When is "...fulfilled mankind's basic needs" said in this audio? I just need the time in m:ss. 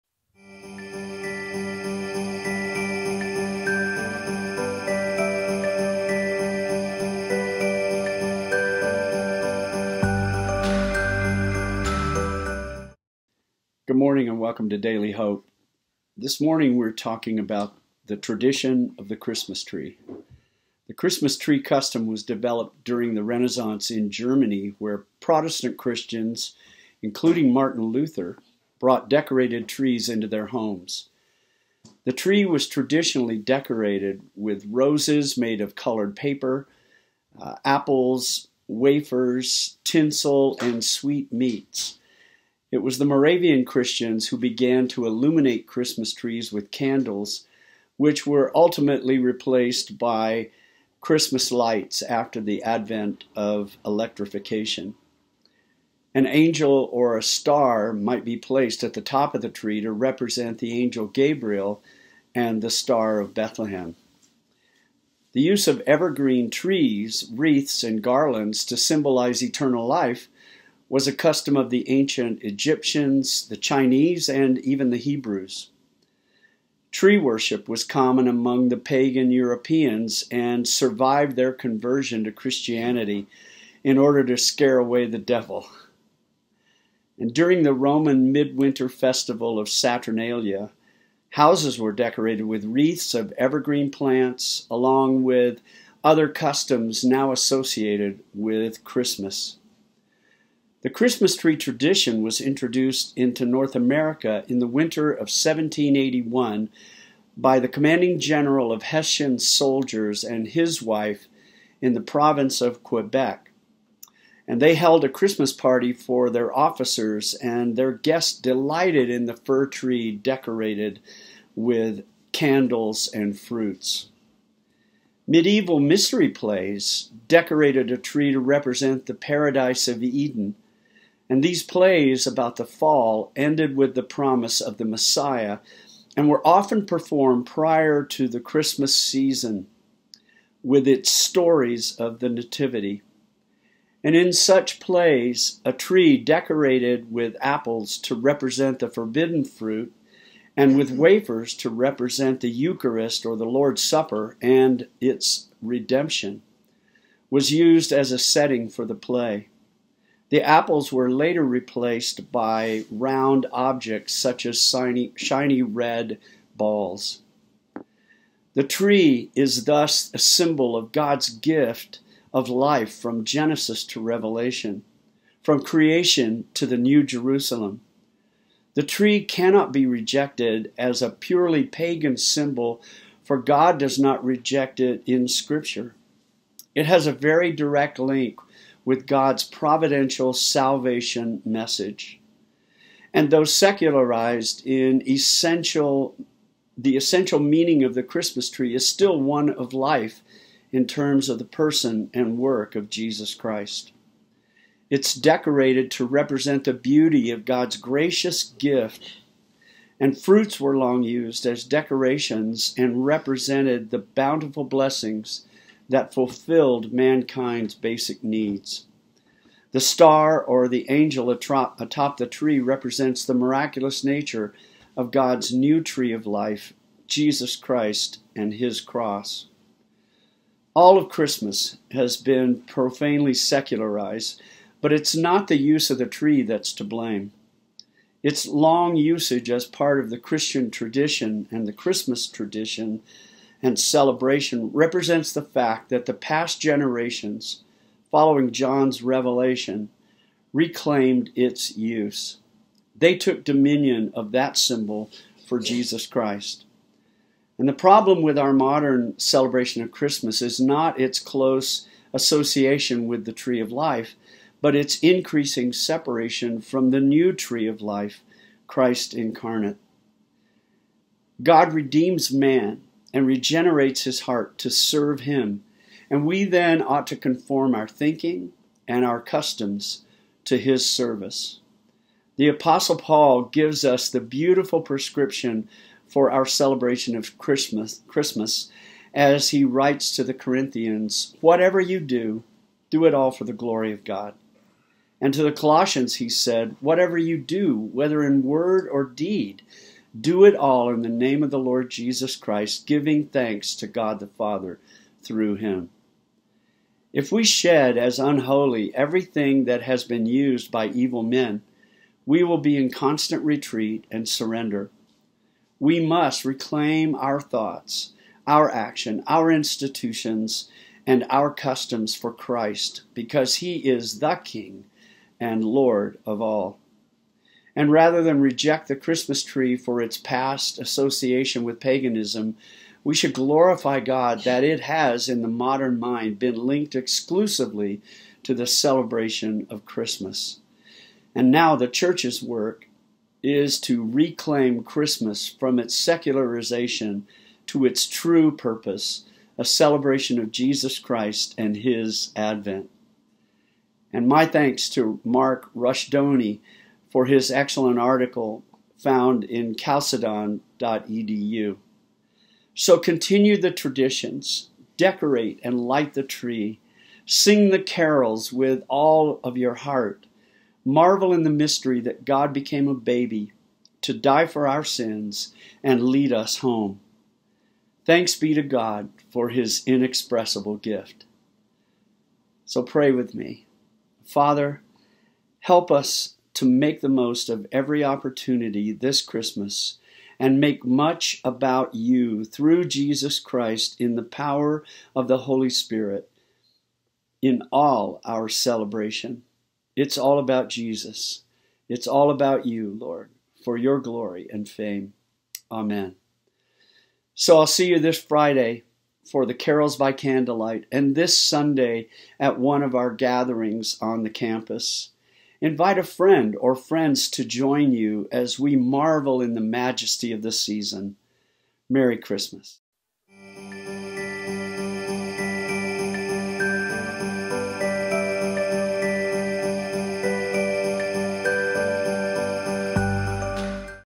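3:36.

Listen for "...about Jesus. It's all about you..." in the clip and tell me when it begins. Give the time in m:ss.
6:40.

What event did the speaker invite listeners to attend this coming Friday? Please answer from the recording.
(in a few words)
Carols by Candlelight.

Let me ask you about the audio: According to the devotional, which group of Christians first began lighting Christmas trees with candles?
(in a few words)
Moravian Christians.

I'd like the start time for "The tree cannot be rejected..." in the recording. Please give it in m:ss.
2:58.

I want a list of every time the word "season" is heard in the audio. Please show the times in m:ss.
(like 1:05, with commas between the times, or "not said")
2:18, 7:00.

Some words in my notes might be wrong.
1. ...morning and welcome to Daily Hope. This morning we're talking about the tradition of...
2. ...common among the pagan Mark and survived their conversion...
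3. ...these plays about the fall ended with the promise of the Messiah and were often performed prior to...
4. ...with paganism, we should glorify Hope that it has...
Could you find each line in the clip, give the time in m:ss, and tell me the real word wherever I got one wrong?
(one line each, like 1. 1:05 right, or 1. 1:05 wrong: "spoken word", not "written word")
1. 0:13 right
2. 1:17 wrong: "Europeans", not "Mark"
3. 2:11 right
4. 5:31 wrong: "God", not "Hope".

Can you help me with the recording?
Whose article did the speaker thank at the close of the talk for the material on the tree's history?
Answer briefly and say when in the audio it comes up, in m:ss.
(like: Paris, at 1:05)
Mark Rushdoony, at 5:55.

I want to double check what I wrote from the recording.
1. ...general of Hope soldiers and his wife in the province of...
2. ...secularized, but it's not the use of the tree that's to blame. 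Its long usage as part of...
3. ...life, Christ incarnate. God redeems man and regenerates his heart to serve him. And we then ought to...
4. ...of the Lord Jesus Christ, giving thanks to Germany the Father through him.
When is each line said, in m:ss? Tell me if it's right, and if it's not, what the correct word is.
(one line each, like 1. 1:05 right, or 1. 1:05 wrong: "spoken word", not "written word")
1. 1:48 wrong: "Hessian", not "Hope"
2. 3:53 right
3. 4:27 right
4. 5:01 wrong: "God", not "Germany".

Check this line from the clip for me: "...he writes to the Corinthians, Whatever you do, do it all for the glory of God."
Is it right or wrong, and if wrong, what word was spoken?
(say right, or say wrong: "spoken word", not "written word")
right.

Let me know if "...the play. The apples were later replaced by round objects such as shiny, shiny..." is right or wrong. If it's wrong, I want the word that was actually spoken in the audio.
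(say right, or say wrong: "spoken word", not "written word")
right.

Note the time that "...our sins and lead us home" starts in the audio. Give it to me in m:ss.
6:14.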